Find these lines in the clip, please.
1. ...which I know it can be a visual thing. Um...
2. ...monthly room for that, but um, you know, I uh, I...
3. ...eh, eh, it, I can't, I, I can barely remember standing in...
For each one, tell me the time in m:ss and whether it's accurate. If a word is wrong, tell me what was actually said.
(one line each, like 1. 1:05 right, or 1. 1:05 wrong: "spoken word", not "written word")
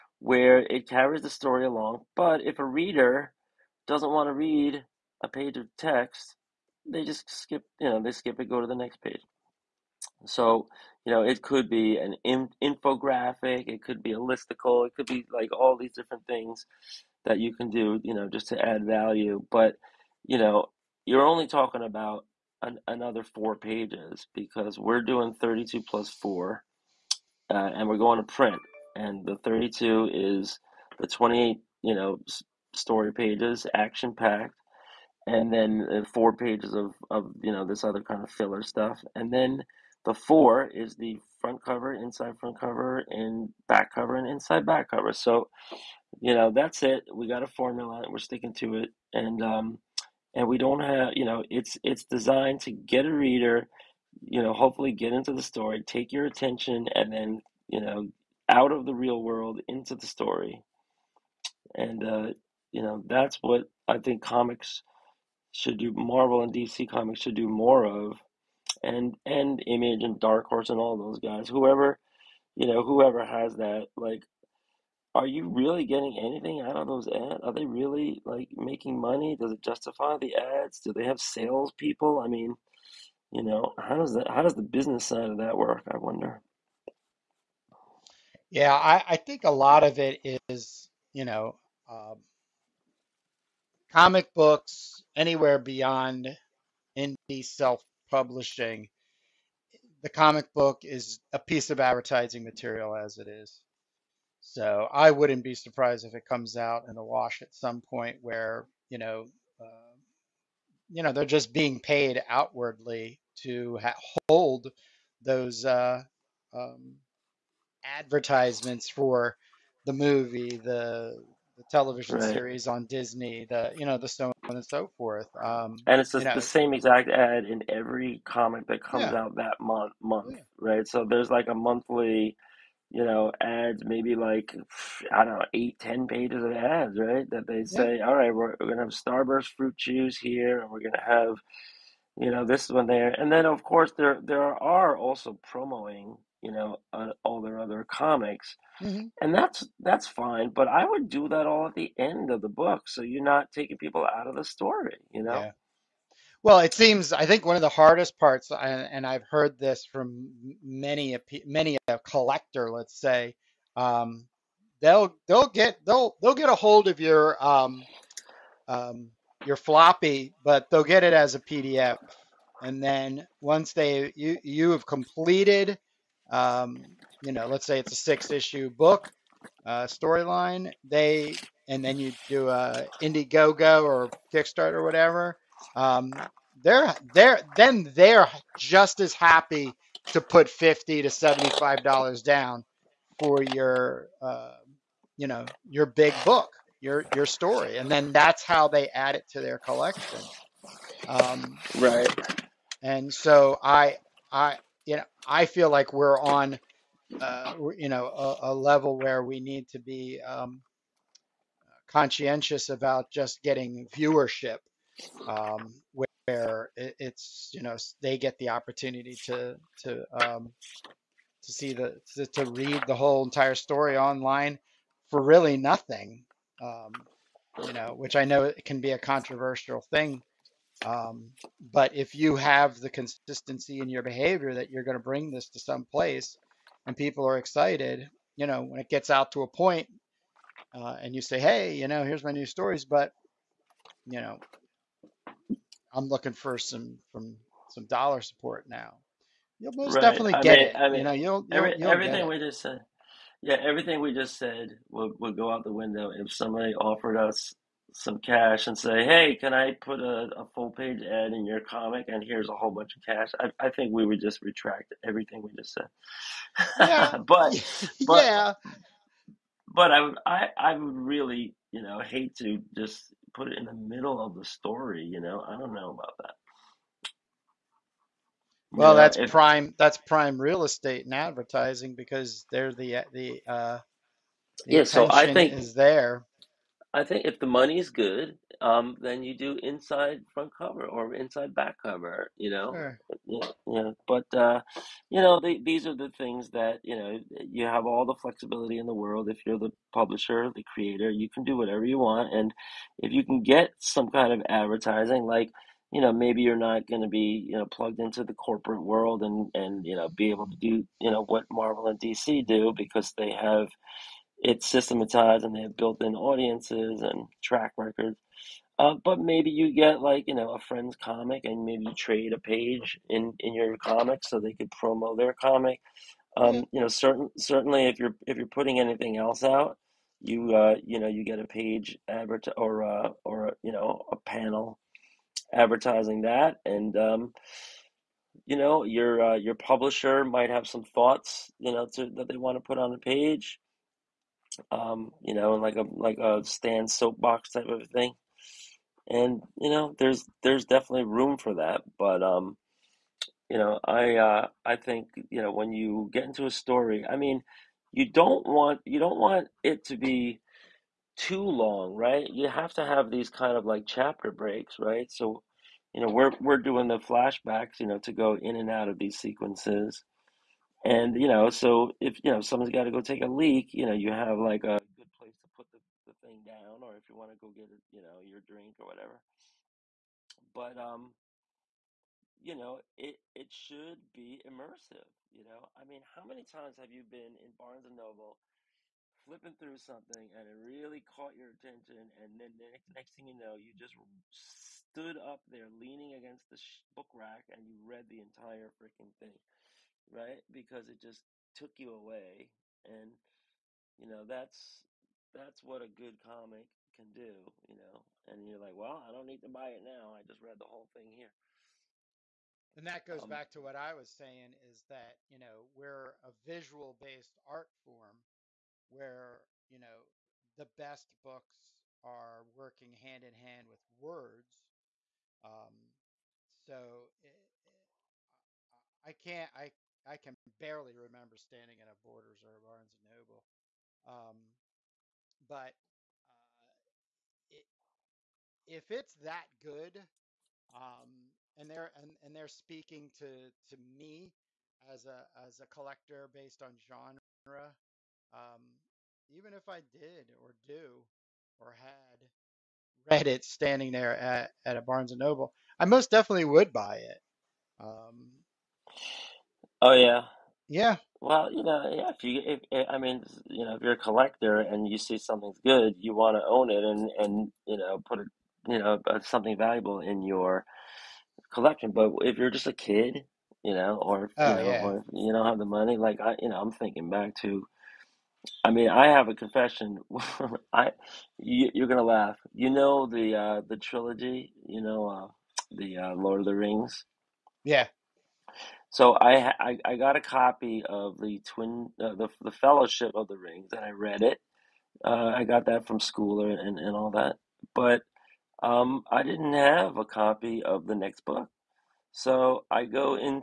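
1. 3:47 wrong: "controversial", not "visual"
2. 5:50 wrong: "definitely", not "monthly"
3. 7:07 right.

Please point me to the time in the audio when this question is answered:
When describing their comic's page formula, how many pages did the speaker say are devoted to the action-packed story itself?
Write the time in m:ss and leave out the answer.
0:30.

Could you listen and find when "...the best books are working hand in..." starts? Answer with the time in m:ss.
7:00.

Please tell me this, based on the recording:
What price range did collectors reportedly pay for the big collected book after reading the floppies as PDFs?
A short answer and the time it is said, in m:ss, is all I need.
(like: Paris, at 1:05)
$50 to $75, at 3:10.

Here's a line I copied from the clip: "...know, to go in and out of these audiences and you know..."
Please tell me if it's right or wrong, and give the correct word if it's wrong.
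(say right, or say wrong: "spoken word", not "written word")
wrong: "sequences", not "audiences".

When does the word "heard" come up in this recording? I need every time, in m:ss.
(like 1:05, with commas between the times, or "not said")
2:39.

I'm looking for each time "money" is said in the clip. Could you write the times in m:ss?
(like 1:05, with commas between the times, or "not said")
1:18, 4:47, 7:55.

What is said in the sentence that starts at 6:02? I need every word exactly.
You have to have these kind of like chapter breaks, right?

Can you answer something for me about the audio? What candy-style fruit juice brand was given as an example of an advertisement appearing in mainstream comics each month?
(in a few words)
Starburst.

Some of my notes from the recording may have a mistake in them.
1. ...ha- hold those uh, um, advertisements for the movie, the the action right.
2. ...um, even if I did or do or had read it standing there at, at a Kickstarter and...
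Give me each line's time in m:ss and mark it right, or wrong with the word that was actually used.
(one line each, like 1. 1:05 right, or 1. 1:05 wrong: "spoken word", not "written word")
1. 1:53 wrong: "television", not "action"
2. 7:28 wrong: "Barnes", not "Kickstarter".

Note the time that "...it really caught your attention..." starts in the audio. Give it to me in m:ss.
6:30.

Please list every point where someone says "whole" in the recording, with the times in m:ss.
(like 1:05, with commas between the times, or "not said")
3:42, 4:22, 6:50.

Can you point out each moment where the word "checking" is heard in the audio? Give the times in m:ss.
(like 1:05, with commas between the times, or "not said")
not said.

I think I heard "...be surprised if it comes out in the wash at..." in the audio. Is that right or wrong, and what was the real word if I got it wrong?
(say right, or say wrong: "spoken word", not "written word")
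right.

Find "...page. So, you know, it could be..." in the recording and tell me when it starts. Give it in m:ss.
0:09.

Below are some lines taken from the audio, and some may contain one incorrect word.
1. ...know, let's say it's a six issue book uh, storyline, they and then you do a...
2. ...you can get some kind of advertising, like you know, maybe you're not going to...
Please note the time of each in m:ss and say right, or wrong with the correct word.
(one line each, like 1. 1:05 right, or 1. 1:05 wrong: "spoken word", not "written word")
1. 2:57 right
2. 5:03 right.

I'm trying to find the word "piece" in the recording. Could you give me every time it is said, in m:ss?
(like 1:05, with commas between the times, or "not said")
1:41.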